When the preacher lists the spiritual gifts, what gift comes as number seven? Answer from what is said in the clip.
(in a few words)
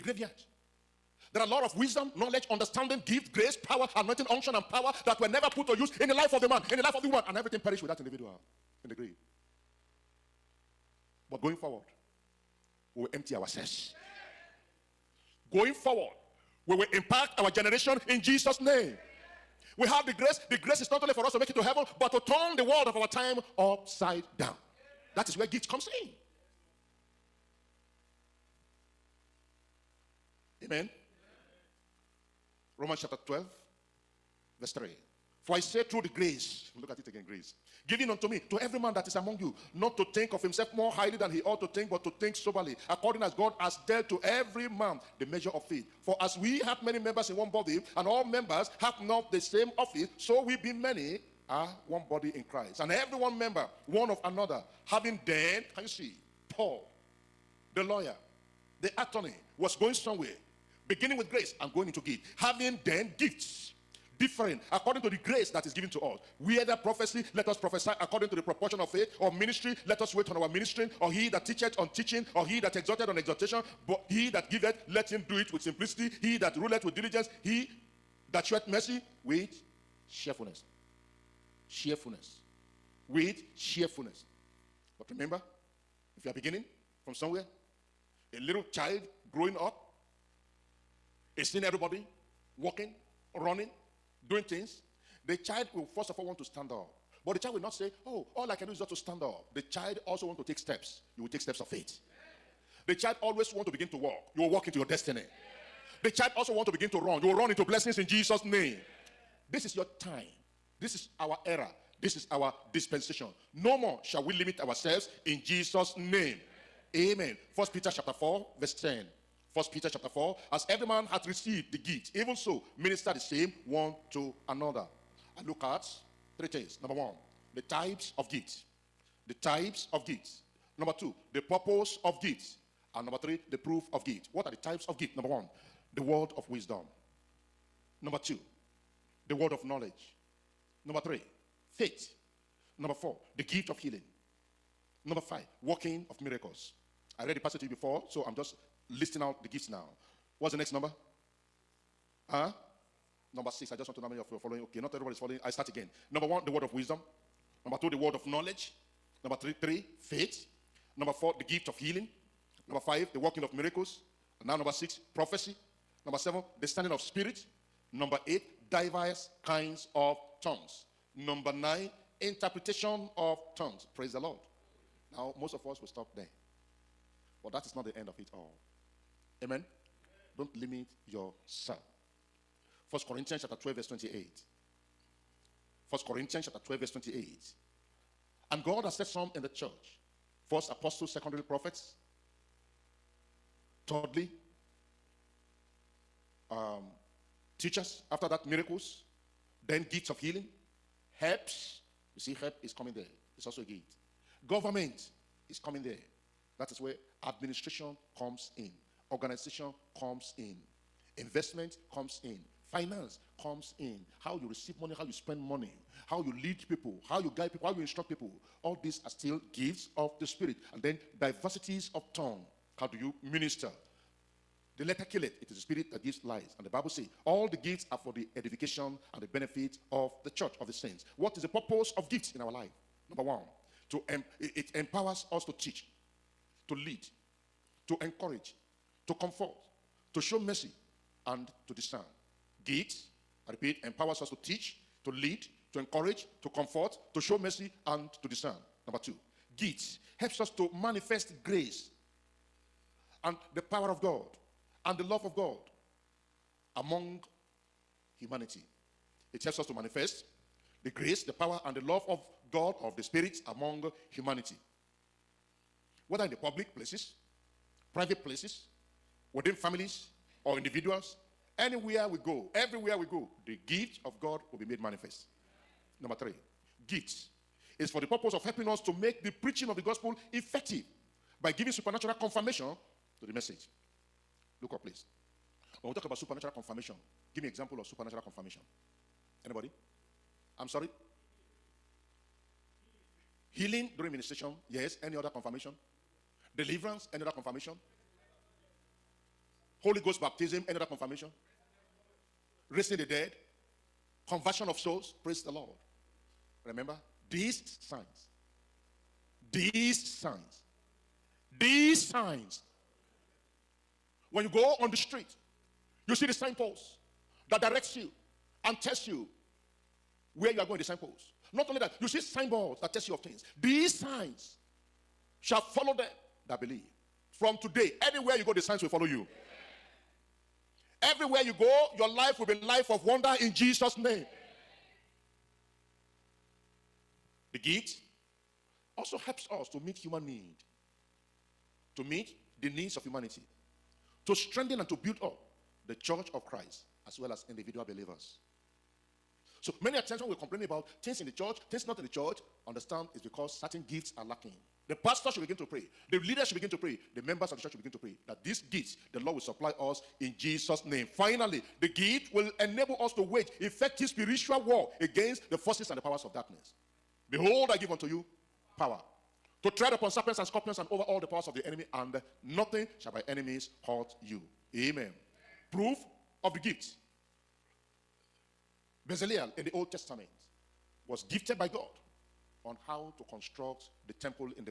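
Discerning of spirit.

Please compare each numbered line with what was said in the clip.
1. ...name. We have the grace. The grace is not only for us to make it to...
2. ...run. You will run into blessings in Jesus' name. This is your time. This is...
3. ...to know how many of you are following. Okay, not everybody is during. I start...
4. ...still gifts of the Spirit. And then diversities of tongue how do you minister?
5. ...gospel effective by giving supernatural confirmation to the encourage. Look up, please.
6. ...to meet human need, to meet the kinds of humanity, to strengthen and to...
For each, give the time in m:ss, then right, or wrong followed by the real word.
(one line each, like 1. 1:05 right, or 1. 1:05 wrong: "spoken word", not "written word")
1. 0:18 right
2. 1:46 right
3. 2:33 wrong: "following", not "during"
4. 3:39 right
5. 4:39 wrong: "message", not "encourage"
6. 5:39 wrong: "needs", not "kinds".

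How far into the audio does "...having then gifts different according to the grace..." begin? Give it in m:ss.
1:02.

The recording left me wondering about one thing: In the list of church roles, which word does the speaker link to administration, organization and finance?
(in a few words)
Government.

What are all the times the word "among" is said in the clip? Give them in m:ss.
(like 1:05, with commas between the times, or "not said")
0:39, 4:16, 4:23.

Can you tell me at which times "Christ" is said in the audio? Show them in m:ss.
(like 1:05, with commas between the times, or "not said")
0:52, 5:46.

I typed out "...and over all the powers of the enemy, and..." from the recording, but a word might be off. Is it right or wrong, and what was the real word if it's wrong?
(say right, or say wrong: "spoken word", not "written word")
right.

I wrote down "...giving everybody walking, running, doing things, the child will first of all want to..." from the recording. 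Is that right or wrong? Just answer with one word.
wrong.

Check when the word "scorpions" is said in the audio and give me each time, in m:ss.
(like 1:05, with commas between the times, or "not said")
6:10.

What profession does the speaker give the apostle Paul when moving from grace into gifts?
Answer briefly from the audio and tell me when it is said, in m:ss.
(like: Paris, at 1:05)
Lawyer, at 0:57.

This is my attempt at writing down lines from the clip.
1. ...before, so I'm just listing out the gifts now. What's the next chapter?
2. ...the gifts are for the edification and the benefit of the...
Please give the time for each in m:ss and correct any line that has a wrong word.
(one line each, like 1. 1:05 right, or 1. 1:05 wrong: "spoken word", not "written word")
1. 2:27 wrong: "number", not "chapter"
2. 3:47 right.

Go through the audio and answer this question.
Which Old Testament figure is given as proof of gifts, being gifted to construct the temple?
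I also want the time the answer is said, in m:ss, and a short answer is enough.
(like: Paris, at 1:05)
Bezaleel, at 6:19.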